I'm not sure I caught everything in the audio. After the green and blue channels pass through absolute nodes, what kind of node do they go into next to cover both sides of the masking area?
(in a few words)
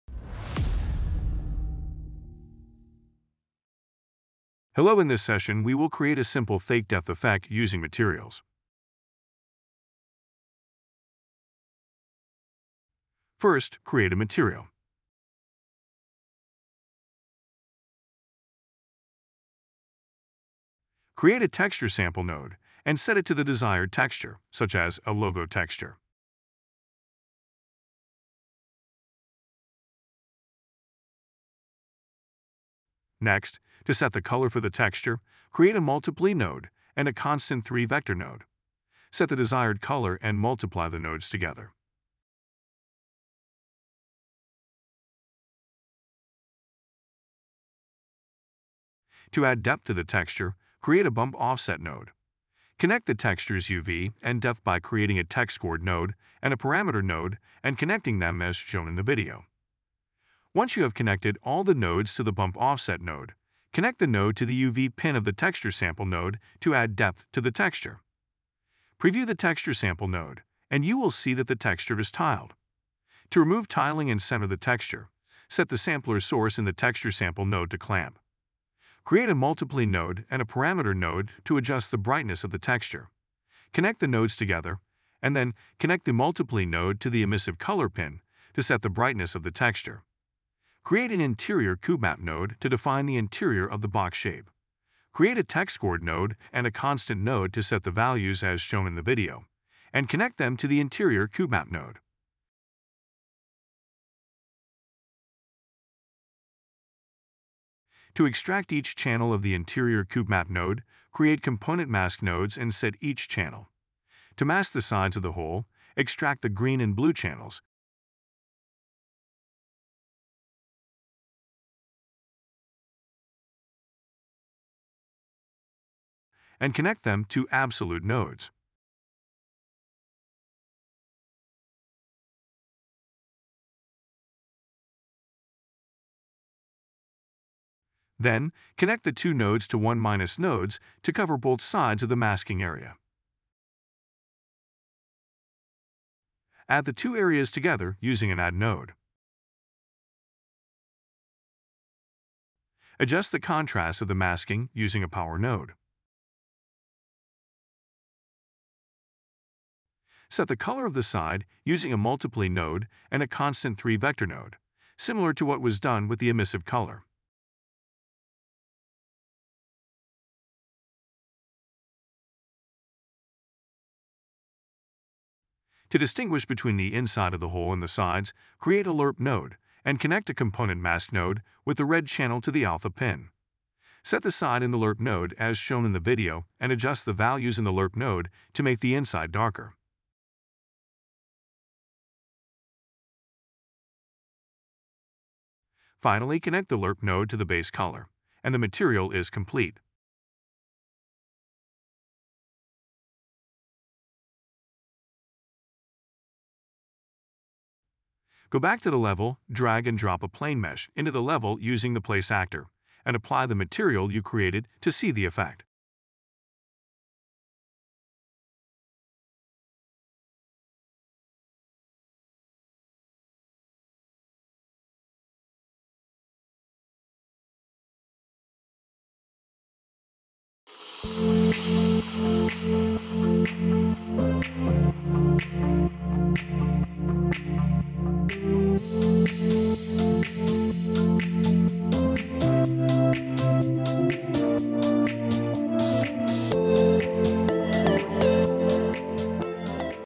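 1 minus nodes.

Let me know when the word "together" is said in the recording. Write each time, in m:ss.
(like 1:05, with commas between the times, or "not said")
0:41, 1:24, 2:27.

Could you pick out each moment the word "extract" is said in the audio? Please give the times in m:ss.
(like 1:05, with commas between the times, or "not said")
1:48, 1:55.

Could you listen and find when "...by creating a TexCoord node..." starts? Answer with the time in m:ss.
0:54.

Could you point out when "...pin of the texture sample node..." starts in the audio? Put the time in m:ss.
1:04.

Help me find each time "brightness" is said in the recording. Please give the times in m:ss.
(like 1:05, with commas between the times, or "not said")
1:21, 1:28.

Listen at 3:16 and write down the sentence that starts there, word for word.
Finally, connect the LERP node to the base color, and the material is complete.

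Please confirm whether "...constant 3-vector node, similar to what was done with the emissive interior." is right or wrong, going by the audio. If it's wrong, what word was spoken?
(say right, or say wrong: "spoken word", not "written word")
wrong: "color", not "interior".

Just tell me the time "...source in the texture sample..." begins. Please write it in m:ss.
1:16.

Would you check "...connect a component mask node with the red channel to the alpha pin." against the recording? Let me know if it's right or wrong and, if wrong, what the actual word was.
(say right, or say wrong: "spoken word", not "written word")
right.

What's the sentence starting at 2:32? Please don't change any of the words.
Adjust the contrast of the masking using a power node.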